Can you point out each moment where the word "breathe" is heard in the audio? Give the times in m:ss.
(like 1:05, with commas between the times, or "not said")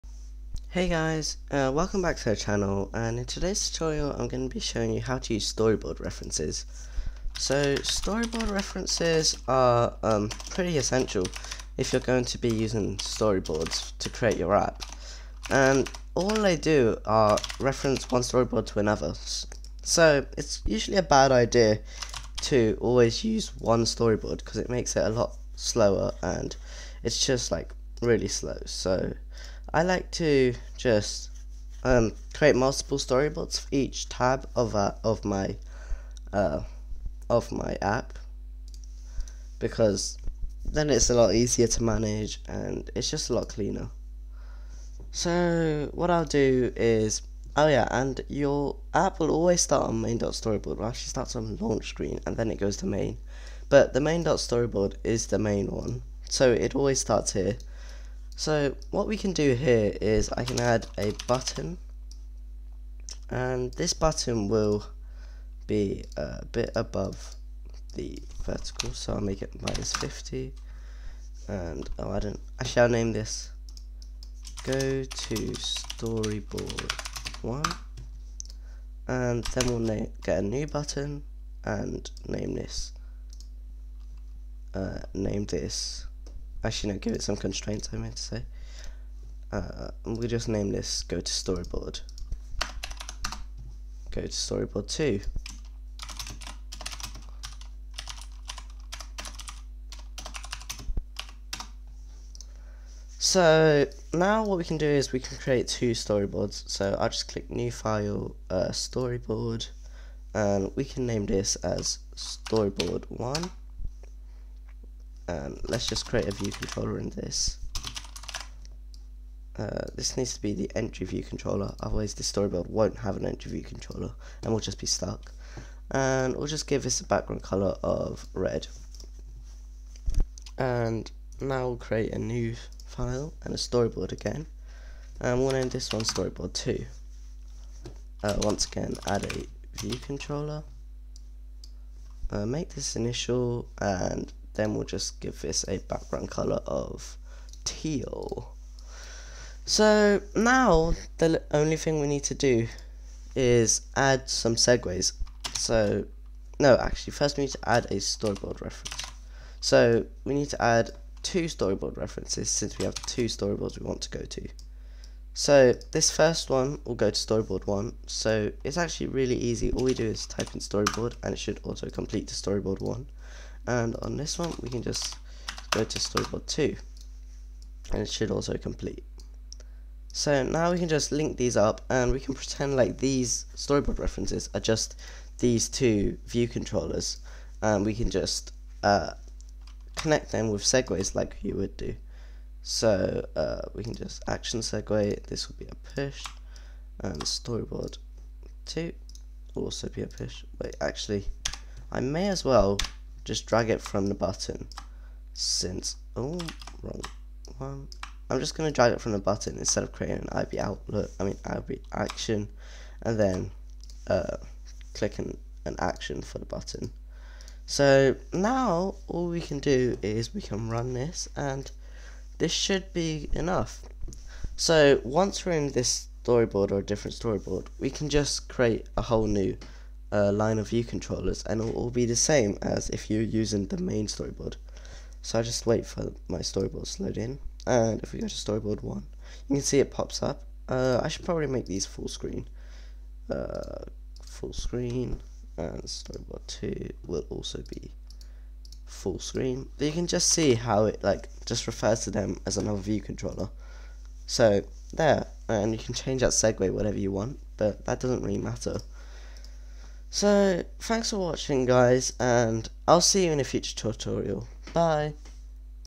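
not said.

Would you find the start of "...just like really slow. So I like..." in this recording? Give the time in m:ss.
0:27.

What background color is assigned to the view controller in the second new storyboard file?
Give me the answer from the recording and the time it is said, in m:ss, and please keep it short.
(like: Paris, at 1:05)
Teal, at 2:27.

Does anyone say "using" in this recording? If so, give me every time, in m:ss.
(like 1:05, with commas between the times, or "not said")
0:12, 3:53.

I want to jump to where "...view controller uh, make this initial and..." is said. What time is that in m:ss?
2:19.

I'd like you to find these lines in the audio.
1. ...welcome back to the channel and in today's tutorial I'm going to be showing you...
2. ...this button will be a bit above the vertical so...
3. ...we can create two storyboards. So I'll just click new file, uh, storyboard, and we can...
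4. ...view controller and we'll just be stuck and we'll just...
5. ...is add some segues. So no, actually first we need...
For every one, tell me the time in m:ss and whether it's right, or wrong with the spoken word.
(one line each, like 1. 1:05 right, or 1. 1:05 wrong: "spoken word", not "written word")
1. 0:01 right
2. 1:03 right
3. 1:45 right
4. 2:03 right
5. 2:33 right.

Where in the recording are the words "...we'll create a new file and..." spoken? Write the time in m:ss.
2:11.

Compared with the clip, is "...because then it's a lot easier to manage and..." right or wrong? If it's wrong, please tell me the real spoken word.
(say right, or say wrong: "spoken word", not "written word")
right.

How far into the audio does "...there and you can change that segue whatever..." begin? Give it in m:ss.
4:14.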